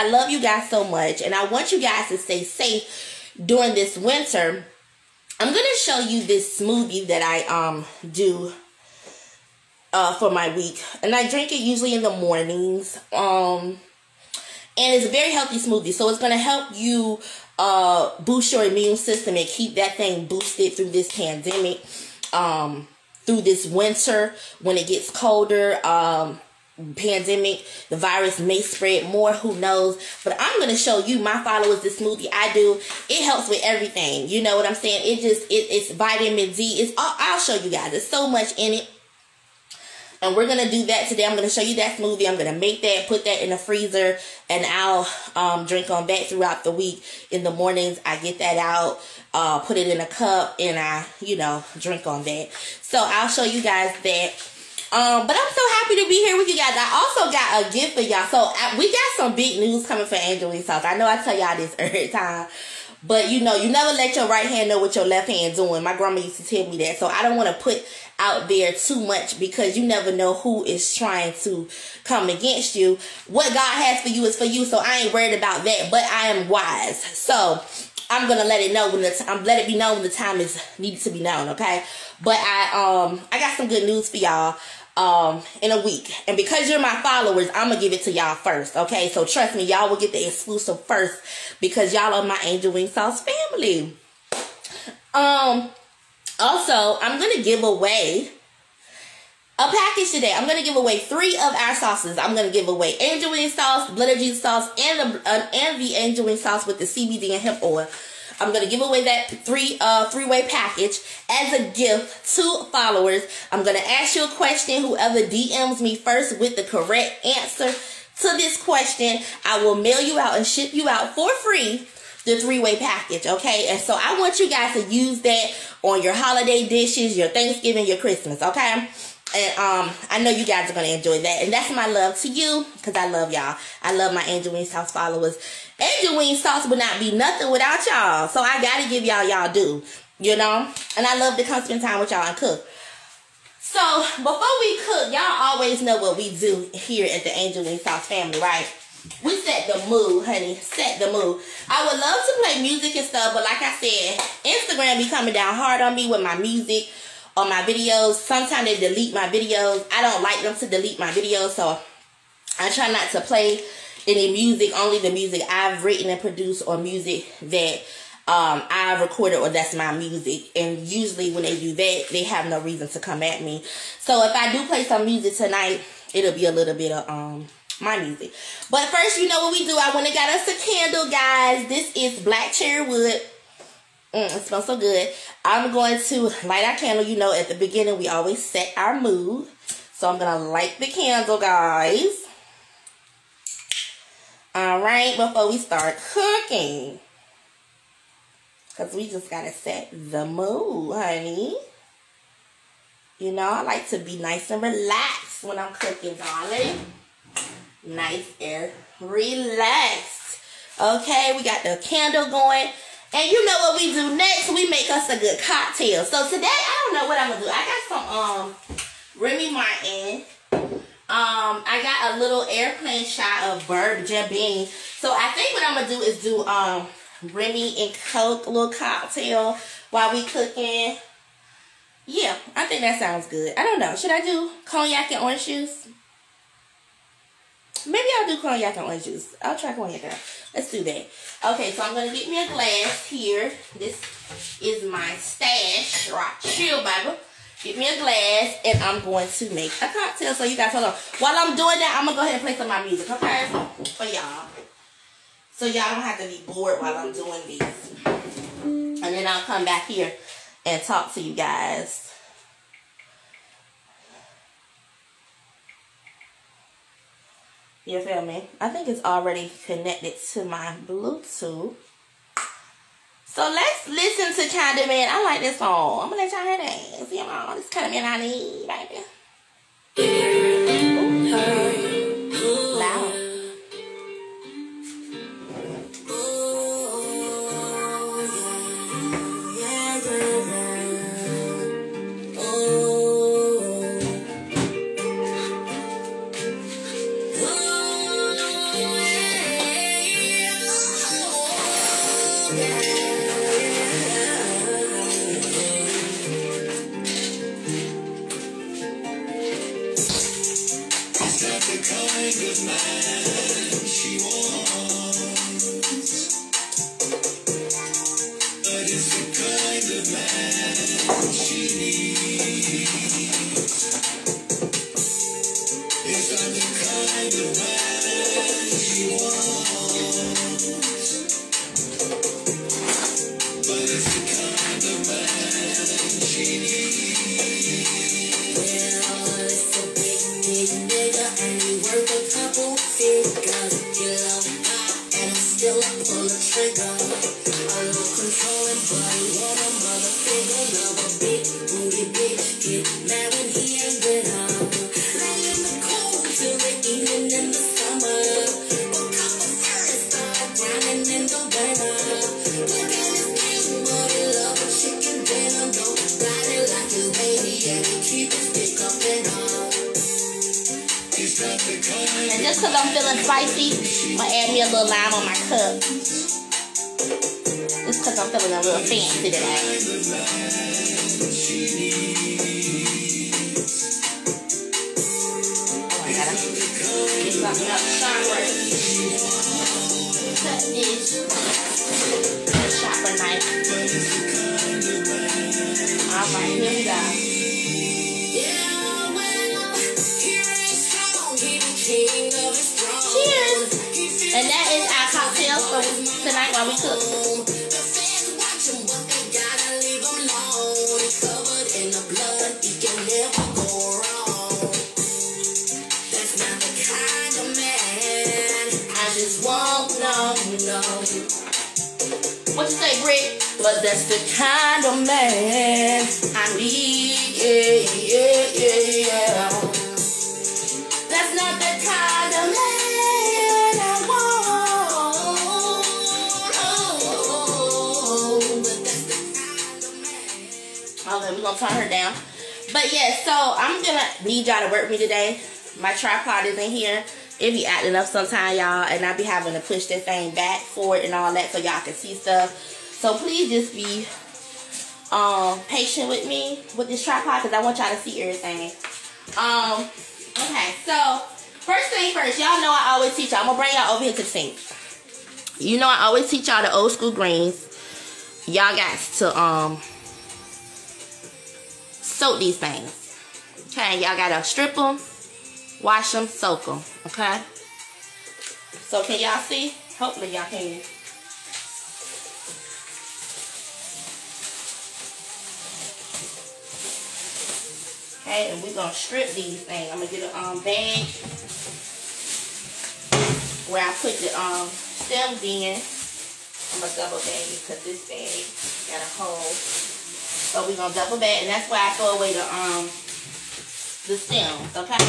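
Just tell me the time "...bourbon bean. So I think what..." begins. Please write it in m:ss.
3:43.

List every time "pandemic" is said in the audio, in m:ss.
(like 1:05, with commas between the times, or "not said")
0:21, 0:26.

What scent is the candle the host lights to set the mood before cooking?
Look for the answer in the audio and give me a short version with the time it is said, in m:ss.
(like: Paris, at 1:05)
black cherry wood, at 3:02.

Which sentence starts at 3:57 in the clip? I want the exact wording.
Maybe I'll do cognac and orange juice.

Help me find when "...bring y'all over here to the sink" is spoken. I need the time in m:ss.
7:43.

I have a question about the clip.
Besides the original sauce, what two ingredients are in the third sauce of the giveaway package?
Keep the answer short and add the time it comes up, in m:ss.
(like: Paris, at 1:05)
CBD and hemp oil, at 1:46.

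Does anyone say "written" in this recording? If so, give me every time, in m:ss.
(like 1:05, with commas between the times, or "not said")
2:45.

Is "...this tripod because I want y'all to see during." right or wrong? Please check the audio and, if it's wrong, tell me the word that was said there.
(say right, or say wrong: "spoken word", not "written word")
wrong: "everything", not "during".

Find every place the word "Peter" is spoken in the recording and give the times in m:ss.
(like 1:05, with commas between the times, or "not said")
not said.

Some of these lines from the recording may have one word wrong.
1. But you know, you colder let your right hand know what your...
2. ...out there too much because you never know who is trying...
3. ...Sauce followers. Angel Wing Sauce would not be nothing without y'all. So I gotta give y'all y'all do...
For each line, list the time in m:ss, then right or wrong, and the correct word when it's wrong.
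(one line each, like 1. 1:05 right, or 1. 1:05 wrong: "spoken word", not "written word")
1. 1:03 wrong: "never", not "colder"
2. 1:08 right
3. 2:14 right.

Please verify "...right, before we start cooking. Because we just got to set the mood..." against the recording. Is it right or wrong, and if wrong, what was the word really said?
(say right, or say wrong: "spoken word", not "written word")
right.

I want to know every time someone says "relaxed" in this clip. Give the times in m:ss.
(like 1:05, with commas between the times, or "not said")
3:24, 3:28.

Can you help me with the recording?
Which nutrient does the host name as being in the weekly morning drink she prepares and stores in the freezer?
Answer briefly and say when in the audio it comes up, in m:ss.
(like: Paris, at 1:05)
vitamin D, at 0:35.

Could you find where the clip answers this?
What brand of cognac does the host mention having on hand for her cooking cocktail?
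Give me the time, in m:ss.
3:39.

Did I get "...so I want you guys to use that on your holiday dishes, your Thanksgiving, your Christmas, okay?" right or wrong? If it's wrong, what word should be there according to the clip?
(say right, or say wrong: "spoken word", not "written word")
right.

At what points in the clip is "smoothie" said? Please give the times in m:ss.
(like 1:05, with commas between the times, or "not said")
0:06, 0:15, 0:31, 0:41.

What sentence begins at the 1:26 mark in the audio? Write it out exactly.
And because you're my followers, I'm gonna give it to y'all first.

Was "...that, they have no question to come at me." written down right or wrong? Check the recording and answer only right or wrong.
wrong.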